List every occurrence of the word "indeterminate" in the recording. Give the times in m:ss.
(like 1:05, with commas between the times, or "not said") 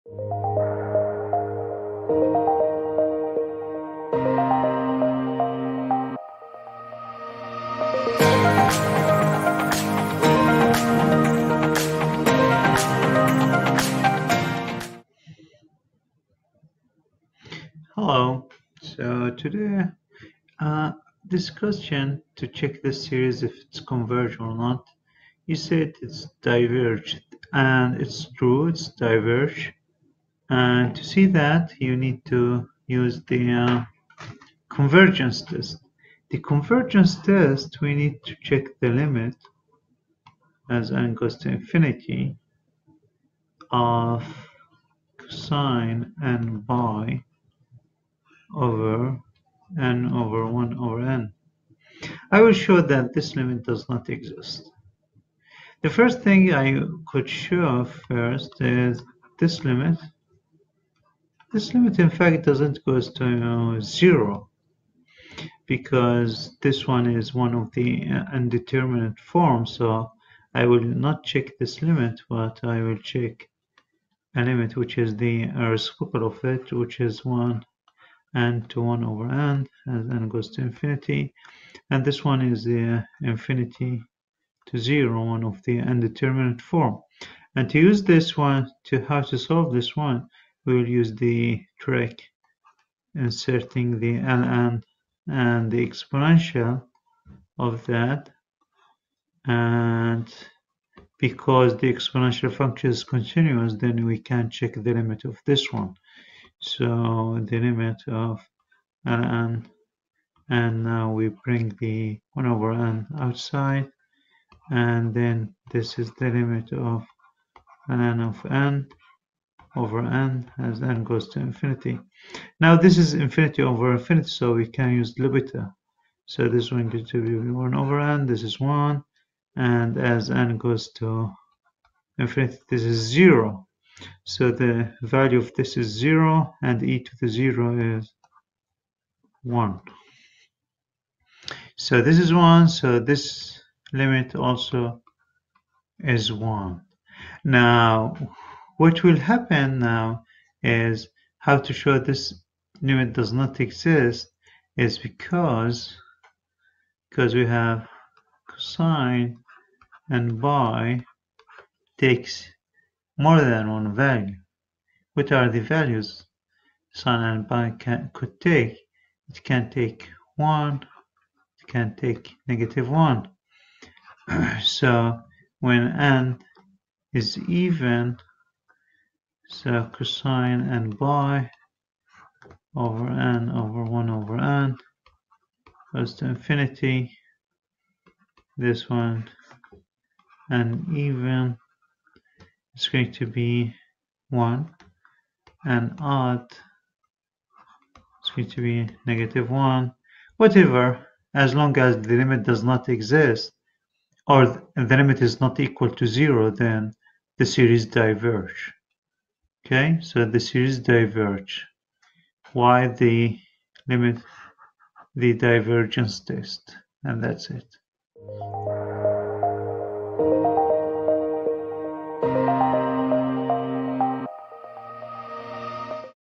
1:08, 1:25.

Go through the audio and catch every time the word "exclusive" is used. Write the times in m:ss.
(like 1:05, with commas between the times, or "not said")
not said.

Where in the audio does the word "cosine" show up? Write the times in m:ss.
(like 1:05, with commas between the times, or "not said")
2:38, 2:59.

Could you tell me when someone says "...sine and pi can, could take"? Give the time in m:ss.
2:46.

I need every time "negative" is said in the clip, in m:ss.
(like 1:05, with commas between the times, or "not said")
2:52, 3:19.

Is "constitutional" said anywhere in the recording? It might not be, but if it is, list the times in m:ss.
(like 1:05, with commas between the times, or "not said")
not said.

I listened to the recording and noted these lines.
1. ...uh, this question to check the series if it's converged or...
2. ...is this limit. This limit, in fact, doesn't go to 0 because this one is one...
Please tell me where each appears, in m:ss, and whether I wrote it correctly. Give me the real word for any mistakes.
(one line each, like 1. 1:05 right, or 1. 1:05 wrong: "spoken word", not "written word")
1. 0:20 right
2. 0:58 right.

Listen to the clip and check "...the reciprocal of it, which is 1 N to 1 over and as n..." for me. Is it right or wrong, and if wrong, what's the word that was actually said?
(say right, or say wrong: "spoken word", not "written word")
right.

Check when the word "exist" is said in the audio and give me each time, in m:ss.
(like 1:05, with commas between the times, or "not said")
0:54, 2:33, 3:22.